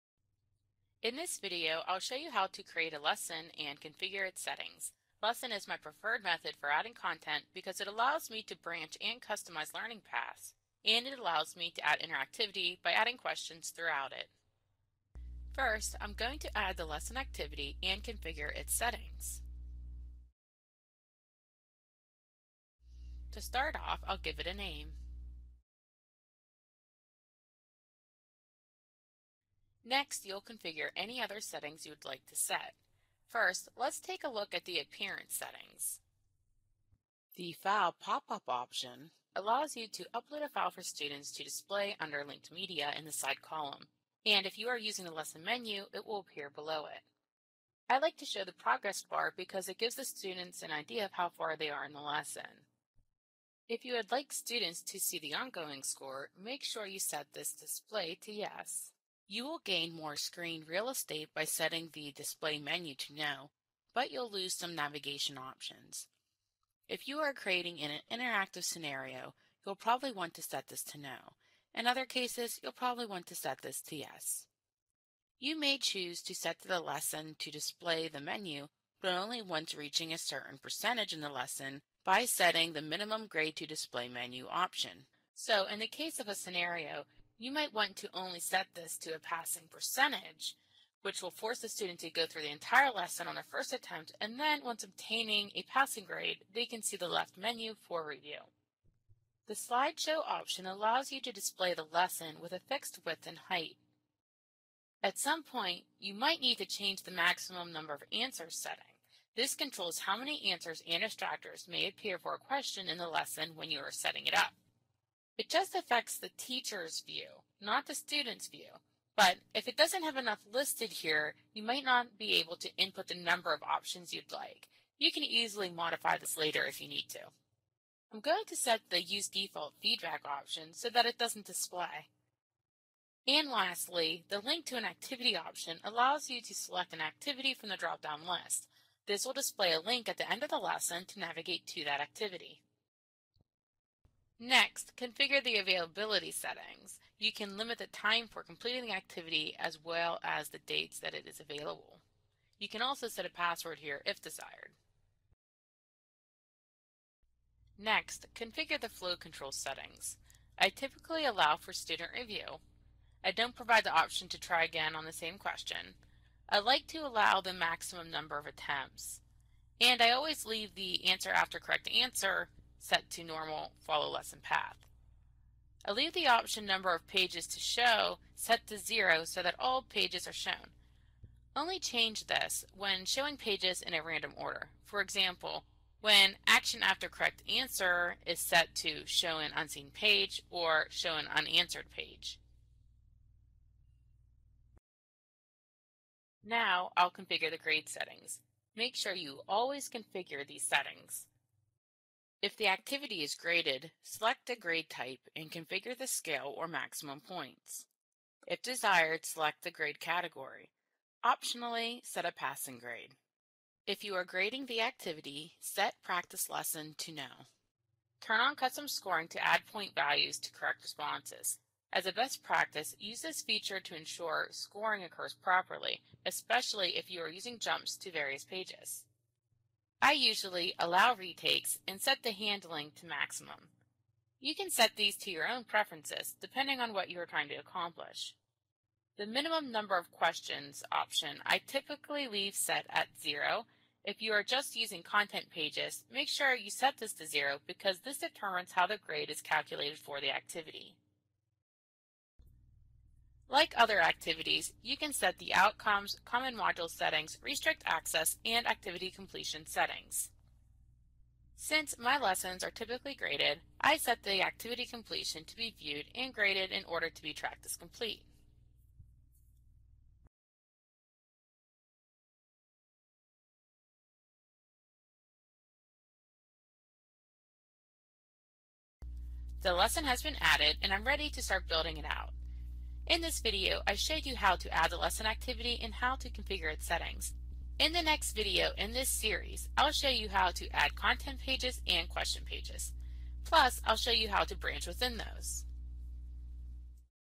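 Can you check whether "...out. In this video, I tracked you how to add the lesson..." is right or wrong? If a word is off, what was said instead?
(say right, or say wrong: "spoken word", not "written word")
wrong: "showed", not "tracked".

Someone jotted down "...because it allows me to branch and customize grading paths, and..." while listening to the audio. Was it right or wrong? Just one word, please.
wrong.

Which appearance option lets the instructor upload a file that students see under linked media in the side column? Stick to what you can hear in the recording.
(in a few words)
File pop-up.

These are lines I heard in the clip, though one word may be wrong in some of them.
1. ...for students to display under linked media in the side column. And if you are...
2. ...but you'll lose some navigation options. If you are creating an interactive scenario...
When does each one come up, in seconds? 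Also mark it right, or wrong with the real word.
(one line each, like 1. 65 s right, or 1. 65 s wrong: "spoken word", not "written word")
1. 40 s right
2. 63 s right.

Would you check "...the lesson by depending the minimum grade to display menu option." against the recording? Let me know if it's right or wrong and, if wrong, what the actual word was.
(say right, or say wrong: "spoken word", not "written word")
wrong: "setting", not "depending".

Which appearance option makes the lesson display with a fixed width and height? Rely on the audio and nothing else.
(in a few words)
Slideshow.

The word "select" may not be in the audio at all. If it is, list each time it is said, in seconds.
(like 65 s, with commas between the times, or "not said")
136 s, 204 s, 209 s.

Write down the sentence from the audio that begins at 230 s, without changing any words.
I usually allow retakes and set the handling to maximum.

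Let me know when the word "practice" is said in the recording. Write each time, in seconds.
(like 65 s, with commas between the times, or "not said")
216 s, 222 s.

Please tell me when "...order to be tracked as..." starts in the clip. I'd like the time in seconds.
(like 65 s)
266 s.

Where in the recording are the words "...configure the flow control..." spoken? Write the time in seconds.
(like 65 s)
158 s.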